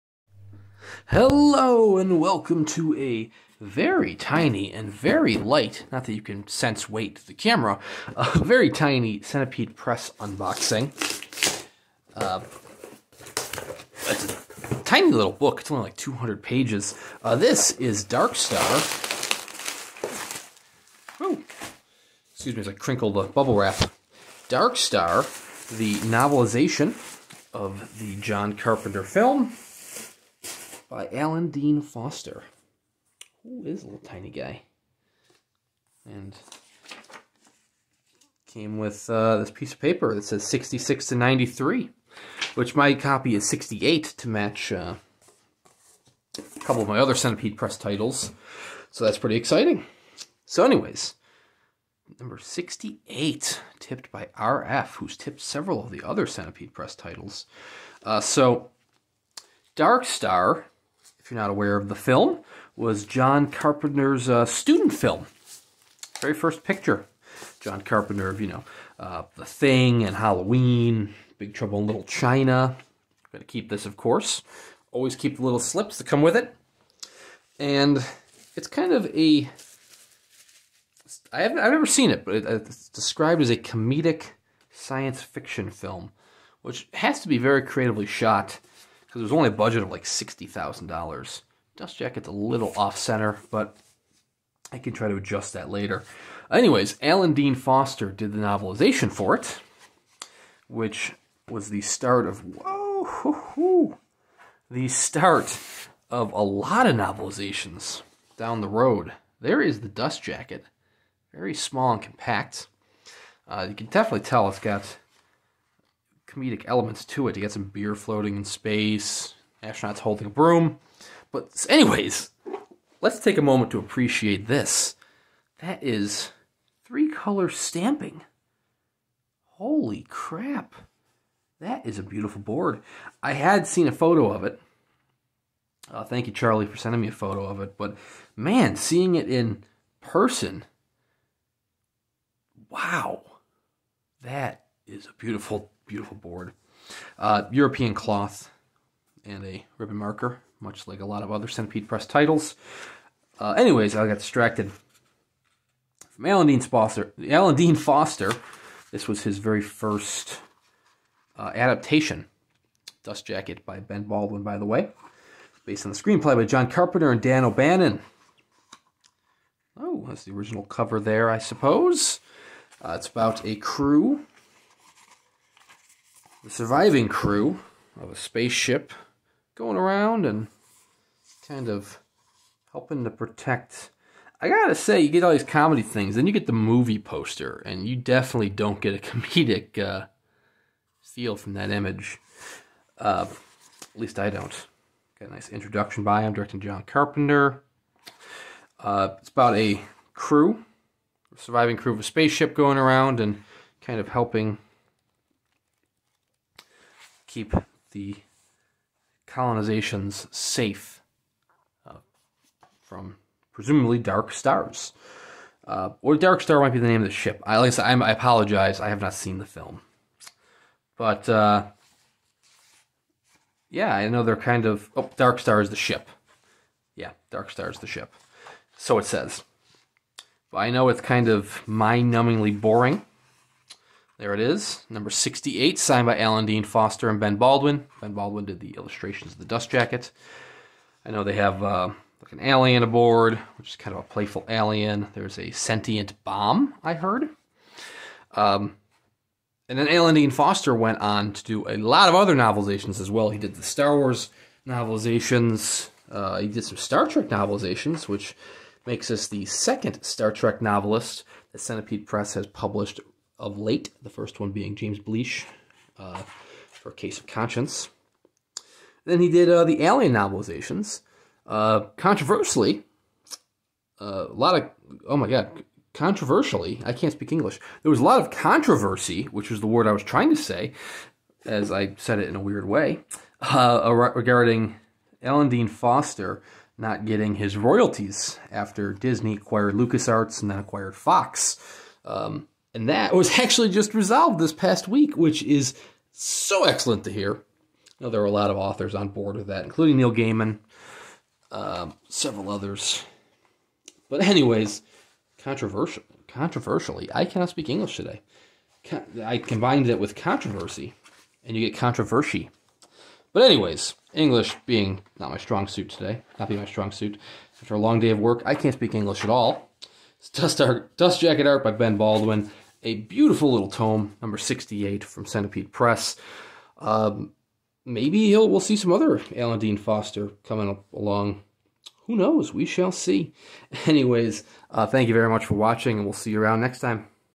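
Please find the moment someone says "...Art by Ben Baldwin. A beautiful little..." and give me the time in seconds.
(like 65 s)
321 s.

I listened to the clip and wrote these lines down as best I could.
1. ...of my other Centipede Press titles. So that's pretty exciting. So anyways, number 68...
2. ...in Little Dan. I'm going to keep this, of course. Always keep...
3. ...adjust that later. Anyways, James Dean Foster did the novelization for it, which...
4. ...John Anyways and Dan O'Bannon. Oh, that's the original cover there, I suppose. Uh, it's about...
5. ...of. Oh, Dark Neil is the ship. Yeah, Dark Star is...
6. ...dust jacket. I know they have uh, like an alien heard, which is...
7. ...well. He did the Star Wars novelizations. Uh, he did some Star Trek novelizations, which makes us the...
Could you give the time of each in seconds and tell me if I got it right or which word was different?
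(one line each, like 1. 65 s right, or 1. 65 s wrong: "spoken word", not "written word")
1. 46 s right
2. 71 s wrong: "China", not "Dan"
3. 95 s wrong: "Alan", not "James"
4. 166 s wrong: "Carpenter", not "Anyways"
5. 224 s wrong: "Star", not "Neil"
6. 239 s wrong: "aboard", not "heard"
7. 253 s right.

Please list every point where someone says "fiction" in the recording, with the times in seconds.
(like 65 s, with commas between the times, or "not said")
85 s.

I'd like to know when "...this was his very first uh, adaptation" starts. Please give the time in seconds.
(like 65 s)
158 s.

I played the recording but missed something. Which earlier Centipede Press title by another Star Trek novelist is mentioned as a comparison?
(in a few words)
Case of Conscience.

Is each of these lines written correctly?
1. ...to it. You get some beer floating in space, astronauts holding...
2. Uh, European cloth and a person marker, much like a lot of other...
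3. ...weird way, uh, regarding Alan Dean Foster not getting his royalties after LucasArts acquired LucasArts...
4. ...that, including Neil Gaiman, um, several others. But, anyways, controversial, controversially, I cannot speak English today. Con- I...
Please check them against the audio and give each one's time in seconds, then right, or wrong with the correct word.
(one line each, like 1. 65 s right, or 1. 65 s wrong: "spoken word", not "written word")
1. 117 s right
2. 147 s wrong: "ribbon", not "person"
3. 282 s wrong: "Disney", not "LucasArts"
4. 299 s right.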